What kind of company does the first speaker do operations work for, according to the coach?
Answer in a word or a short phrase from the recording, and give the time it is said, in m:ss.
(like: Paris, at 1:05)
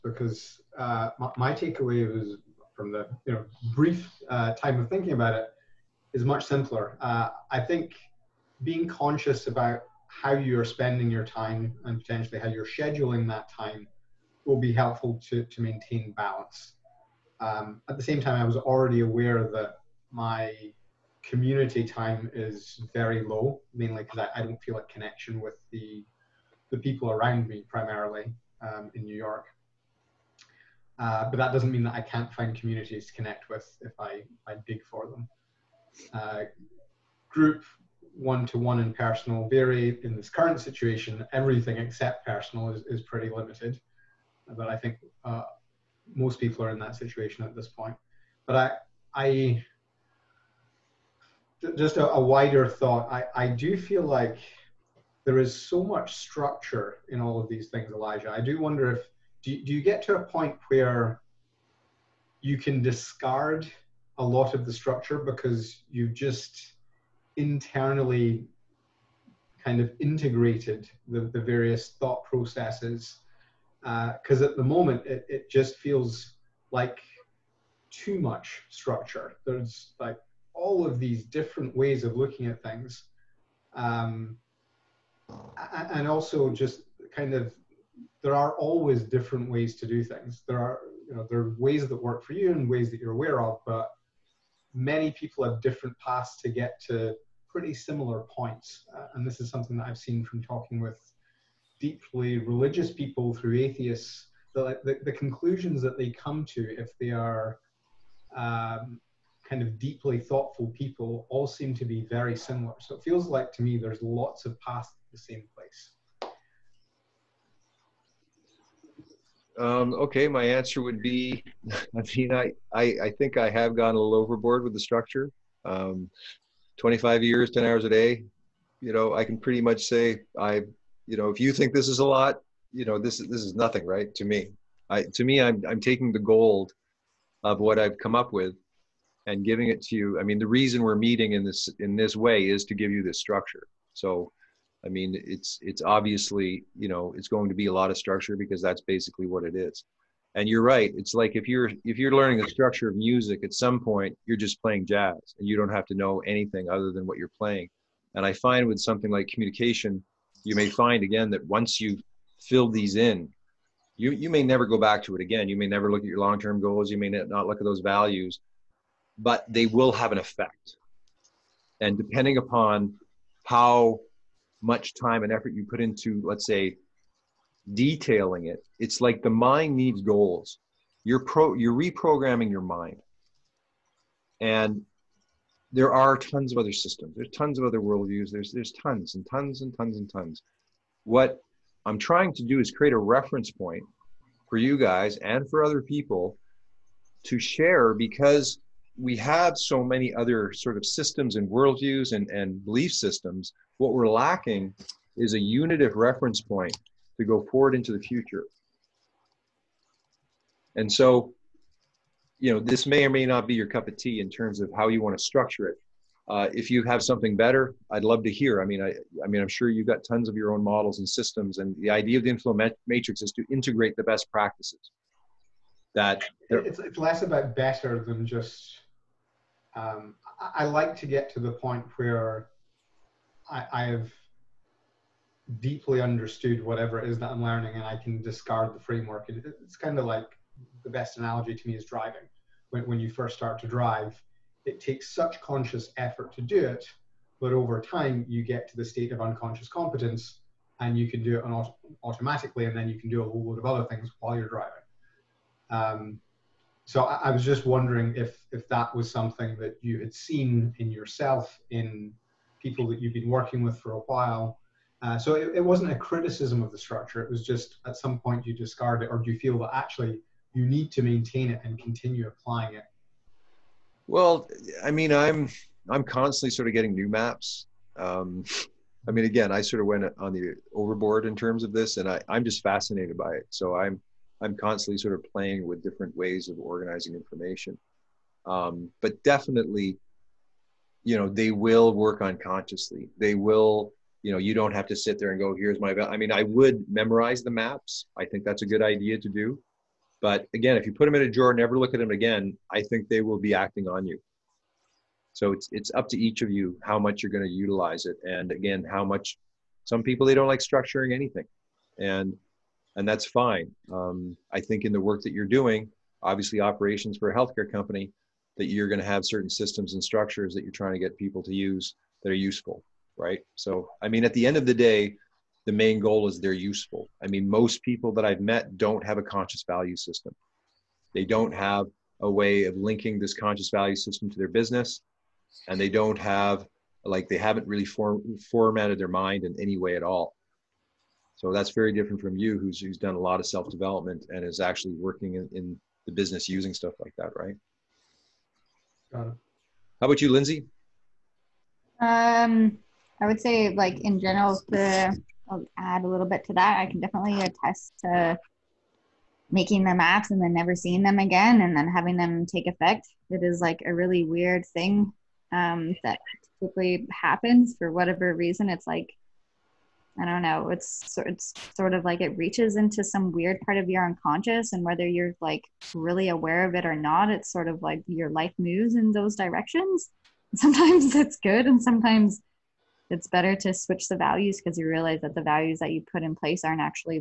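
healthcare company, at 5:17.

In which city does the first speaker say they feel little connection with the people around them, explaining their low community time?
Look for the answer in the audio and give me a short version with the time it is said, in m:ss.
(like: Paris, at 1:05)
New York, at 0:29.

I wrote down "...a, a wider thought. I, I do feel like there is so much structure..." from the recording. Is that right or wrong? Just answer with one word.
right.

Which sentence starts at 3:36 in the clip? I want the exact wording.
Uh, if you have something better, I'd love to hear.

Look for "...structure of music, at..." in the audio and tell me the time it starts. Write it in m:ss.
2:32.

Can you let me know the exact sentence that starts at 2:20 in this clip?
I mean, the reason we're meeting in this in this way is to give you this structure.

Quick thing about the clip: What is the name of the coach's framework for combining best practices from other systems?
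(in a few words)
inflow matrix.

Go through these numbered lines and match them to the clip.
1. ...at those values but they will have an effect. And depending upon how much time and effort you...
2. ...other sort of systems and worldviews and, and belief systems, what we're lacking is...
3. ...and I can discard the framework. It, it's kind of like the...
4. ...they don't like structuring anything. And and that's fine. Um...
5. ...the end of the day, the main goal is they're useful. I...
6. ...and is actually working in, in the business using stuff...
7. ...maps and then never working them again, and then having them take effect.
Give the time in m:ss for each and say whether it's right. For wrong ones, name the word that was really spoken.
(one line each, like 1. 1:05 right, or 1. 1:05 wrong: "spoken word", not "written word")
1. 2:47 right
2. 3:20 right
3. 3:57 right
4. 5:10 right
5. 5:24 right
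6. 5:44 right
7. 5:59 wrong: "seeing", not "working".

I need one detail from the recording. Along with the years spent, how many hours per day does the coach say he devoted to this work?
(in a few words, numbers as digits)
10 hours.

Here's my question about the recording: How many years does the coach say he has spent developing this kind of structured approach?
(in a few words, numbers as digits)
25 years.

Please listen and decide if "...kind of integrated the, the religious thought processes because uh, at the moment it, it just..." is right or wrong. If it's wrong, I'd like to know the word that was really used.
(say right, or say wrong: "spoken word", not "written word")
wrong: "various", not "religious".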